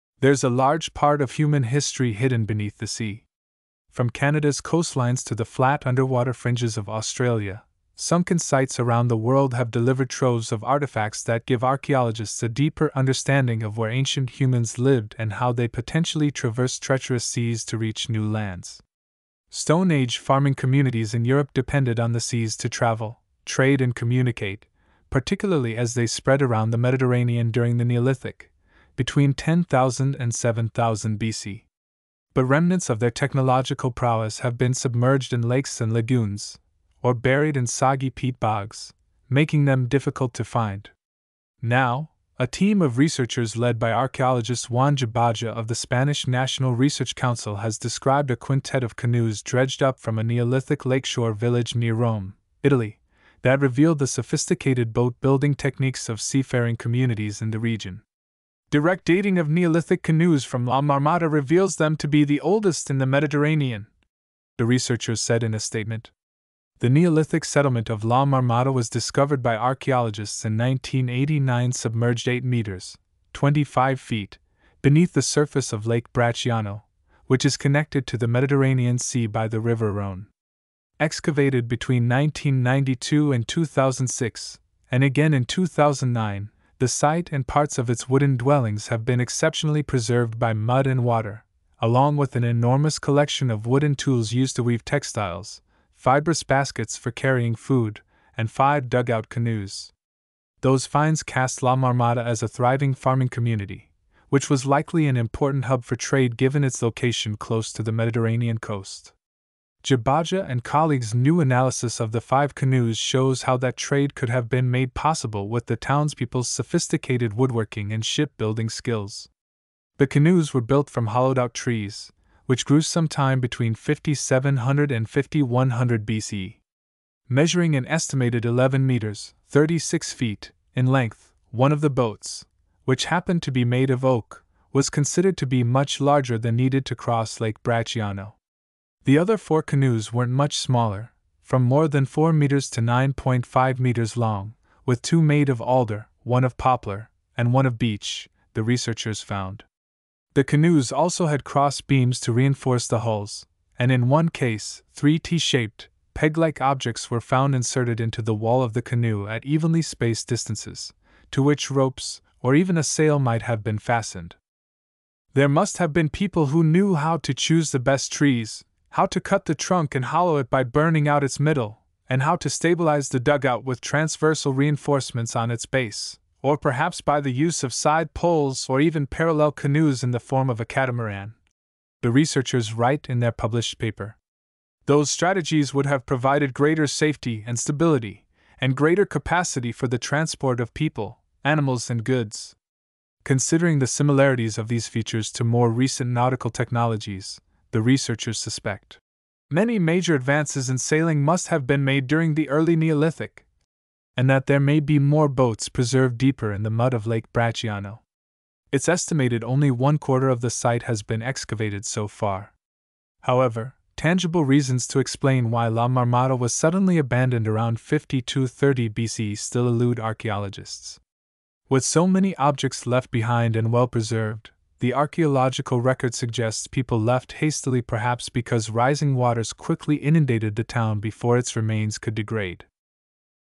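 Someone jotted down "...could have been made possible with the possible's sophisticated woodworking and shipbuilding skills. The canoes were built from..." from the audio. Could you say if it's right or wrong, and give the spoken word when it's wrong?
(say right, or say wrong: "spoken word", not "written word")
wrong: "townspeople", not "possible".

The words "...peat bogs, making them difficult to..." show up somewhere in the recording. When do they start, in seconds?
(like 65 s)
38 s.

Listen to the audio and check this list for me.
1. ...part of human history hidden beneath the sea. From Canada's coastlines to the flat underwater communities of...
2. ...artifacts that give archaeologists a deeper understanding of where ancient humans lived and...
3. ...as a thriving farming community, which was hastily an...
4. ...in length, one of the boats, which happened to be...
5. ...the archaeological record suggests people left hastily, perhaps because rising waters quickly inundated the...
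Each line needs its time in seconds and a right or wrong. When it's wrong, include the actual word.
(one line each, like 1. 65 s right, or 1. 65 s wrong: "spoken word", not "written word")
1. 0 s wrong: "fringes", not "communities"
2. 10 s right
3. 102 s wrong: "likely", not "hastily"
4. 130 s right
5. 224 s right.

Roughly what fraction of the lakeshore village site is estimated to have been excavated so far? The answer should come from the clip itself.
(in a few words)
One quarter.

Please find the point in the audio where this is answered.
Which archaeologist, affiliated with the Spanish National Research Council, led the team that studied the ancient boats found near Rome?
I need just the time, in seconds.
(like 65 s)
44 s.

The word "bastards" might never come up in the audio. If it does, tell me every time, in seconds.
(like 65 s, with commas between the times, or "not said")
not said.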